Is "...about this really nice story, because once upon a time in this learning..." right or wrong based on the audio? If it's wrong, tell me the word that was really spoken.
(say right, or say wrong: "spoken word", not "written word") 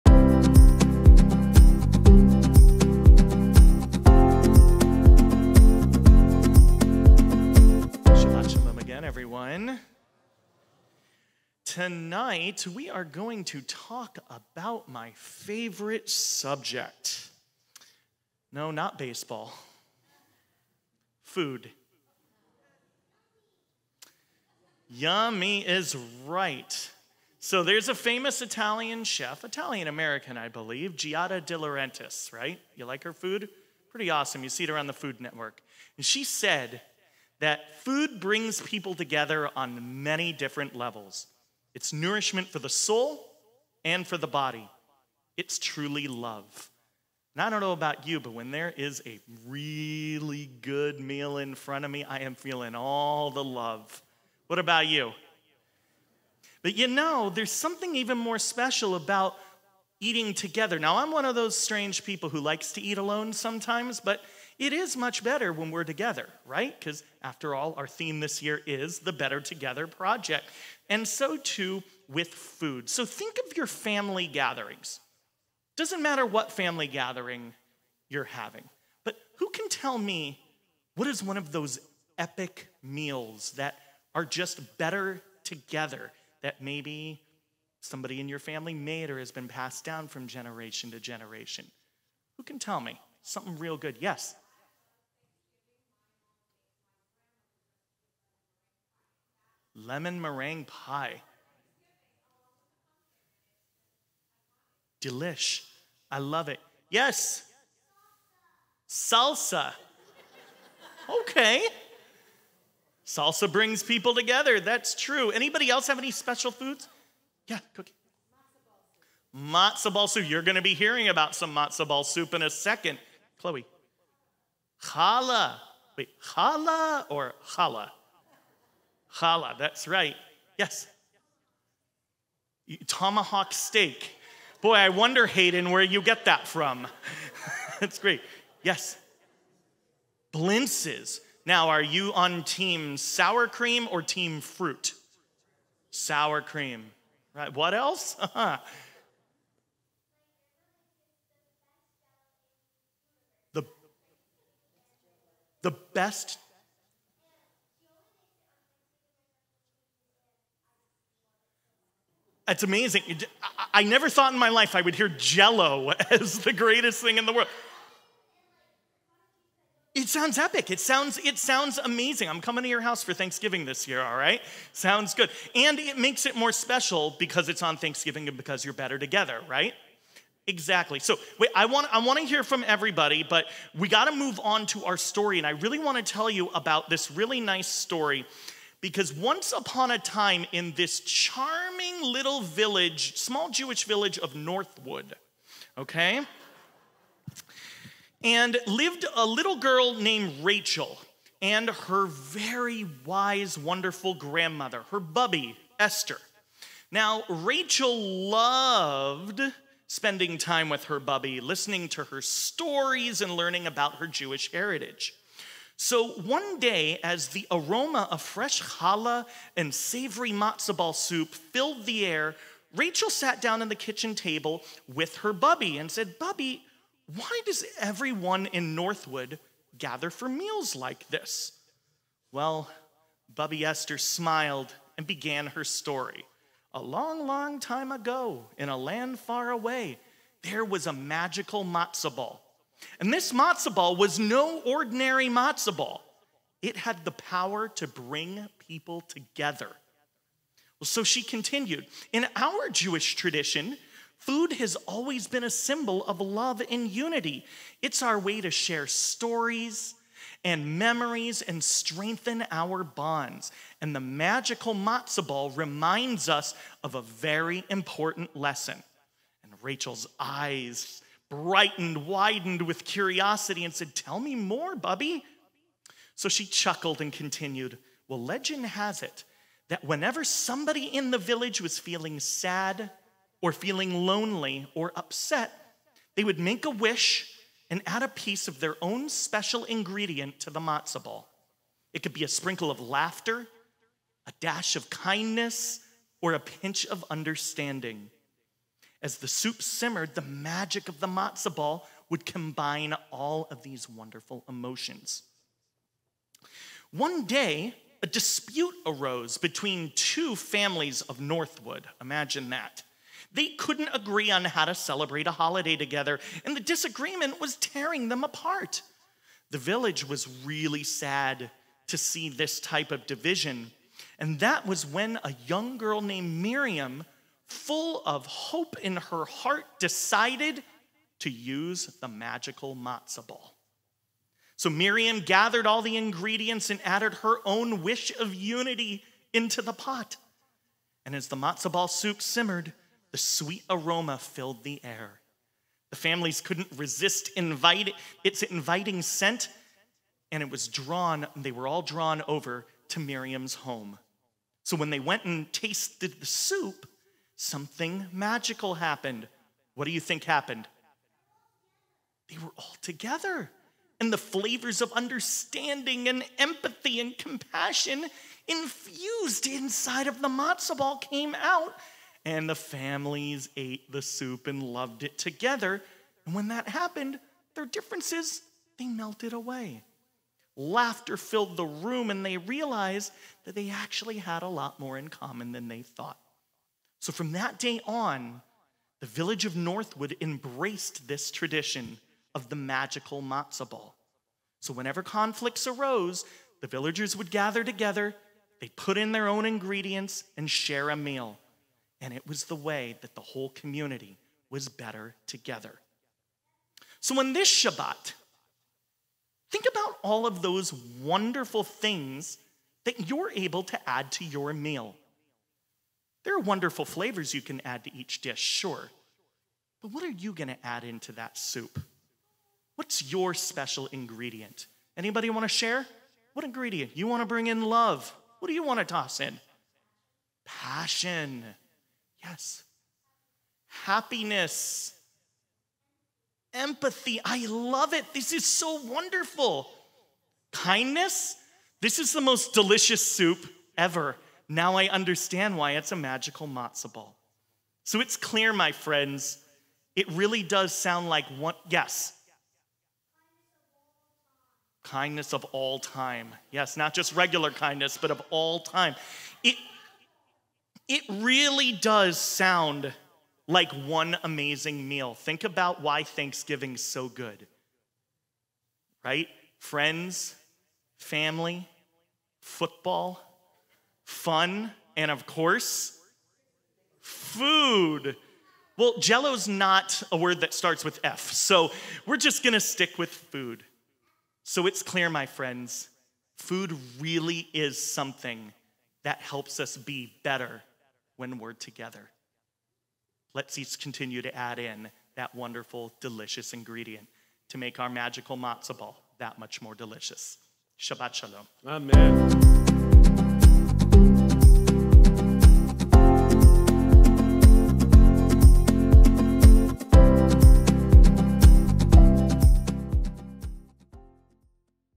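wrong: "charming", not "learning".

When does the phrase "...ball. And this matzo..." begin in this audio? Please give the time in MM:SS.
04:02.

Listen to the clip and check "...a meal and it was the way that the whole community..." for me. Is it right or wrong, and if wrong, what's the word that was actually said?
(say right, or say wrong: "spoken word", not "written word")
right.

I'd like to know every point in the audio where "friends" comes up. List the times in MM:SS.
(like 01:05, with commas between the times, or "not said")
07:28, 07:49, 08:05.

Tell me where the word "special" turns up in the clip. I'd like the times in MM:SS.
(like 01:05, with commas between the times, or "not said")
00:58, 01:56, 02:56, 04:49, 07:03.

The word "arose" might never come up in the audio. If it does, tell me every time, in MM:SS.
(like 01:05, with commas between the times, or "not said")
05:08, 06:35.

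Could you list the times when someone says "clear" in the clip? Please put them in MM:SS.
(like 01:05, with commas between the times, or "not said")
07:28, 08:04.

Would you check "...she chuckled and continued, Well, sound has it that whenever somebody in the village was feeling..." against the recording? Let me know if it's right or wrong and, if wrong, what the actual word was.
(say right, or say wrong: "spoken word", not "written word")
wrong: "legend", not "sound".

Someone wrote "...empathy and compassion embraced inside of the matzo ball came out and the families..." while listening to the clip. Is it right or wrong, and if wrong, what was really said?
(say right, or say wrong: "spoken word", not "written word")
wrong: "infused", not "embraced".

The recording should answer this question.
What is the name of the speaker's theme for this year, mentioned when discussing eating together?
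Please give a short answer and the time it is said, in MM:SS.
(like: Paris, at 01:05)
Better Together Project, at 01:09.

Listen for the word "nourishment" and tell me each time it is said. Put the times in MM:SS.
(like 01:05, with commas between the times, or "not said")
00:41.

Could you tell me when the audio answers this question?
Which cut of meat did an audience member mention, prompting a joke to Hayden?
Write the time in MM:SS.
02:12.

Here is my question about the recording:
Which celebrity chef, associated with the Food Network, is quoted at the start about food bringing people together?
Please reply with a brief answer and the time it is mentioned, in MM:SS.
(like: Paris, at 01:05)
Giada De Laurentiis, at 00:30.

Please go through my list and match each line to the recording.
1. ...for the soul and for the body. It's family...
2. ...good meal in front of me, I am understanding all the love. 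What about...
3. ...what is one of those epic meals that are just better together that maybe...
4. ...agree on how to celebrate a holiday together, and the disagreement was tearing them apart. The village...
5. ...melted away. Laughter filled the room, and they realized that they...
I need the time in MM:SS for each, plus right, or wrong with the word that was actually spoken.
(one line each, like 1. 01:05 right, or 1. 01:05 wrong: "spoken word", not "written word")
1. 00:42 wrong: "truly", not "family"
2. 00:50 wrong: "feeling", not "understanding"
3. 01:20 right
4. 05:13 right
5. 06:18 right.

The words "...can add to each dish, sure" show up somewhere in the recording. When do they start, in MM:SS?
06:57.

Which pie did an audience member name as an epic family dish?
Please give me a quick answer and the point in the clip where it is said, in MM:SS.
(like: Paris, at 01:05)
Lemon meringue pie, at 01:39.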